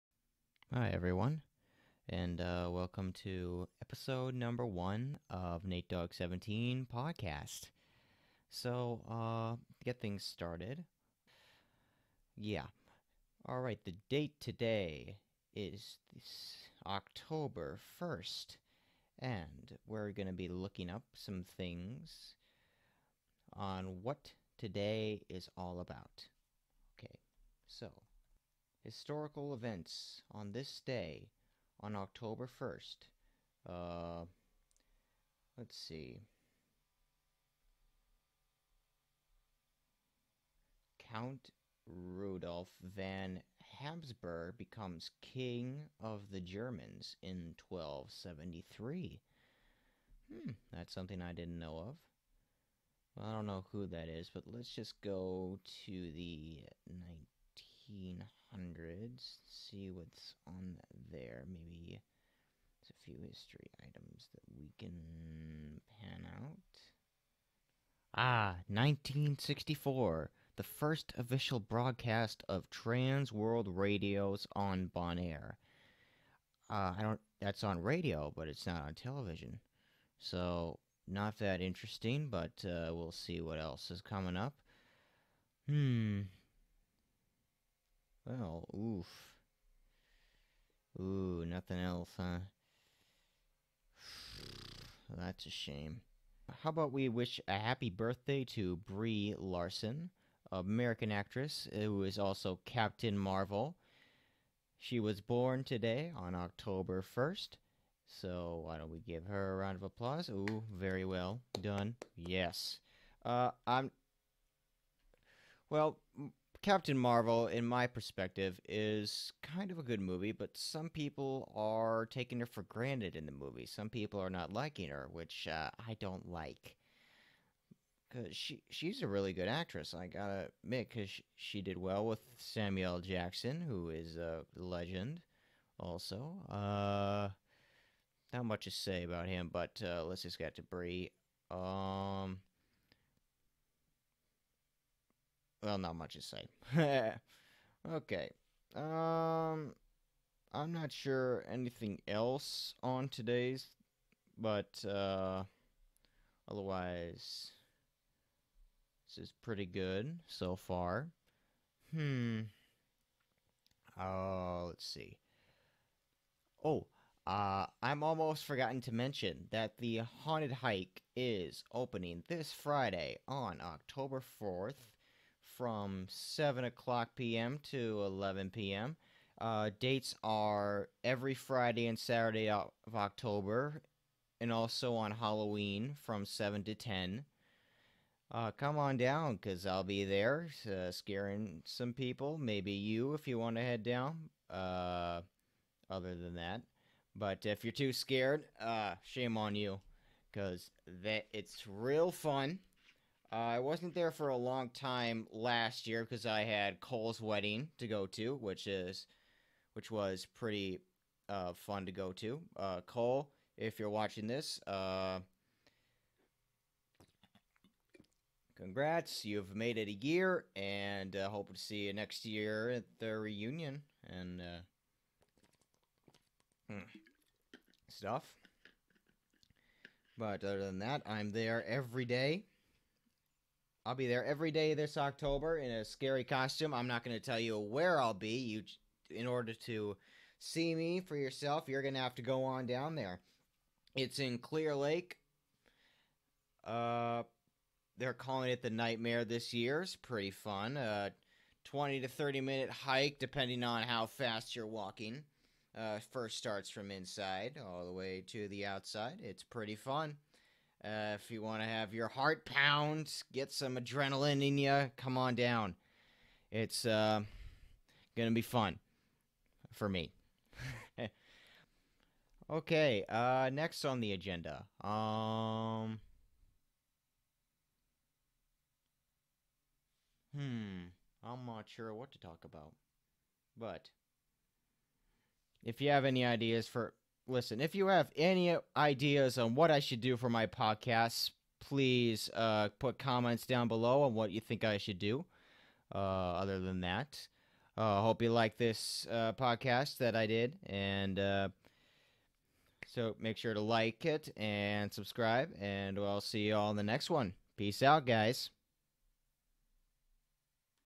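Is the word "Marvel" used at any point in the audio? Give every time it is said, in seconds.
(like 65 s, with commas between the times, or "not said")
103 s, 116 s.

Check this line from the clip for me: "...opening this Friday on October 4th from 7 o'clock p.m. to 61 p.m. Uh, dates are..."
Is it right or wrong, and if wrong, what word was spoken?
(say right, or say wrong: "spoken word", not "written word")
wrong: "11", not "61".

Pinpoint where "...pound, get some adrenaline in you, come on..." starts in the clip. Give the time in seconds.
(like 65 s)
262 s.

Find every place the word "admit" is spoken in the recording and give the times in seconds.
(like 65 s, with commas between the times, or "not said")
130 s.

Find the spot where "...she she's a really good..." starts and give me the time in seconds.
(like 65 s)
128 s.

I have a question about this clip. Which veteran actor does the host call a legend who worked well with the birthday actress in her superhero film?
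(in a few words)
Samuel Jackson.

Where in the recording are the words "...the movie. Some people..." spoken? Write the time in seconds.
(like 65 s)
123 s.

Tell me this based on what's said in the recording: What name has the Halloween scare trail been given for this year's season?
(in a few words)
the Nightmare.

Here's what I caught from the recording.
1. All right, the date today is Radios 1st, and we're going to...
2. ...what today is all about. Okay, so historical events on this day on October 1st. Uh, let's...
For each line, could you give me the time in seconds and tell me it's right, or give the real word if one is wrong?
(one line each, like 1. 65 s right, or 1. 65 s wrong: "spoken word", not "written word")
1. 13 s wrong: "October", not "Radios"
2. 24 s right.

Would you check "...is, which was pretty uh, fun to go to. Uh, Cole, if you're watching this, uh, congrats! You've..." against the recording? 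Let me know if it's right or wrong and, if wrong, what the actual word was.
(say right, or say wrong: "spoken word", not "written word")
right.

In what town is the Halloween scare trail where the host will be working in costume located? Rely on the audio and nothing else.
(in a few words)
Clear Lake.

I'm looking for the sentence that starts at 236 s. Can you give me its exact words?
I'm not going to tell you where I'll be.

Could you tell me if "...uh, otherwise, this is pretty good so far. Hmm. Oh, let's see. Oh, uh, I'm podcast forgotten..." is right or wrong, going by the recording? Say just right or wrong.
wrong.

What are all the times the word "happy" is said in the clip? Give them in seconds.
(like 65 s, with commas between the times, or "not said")
97 s.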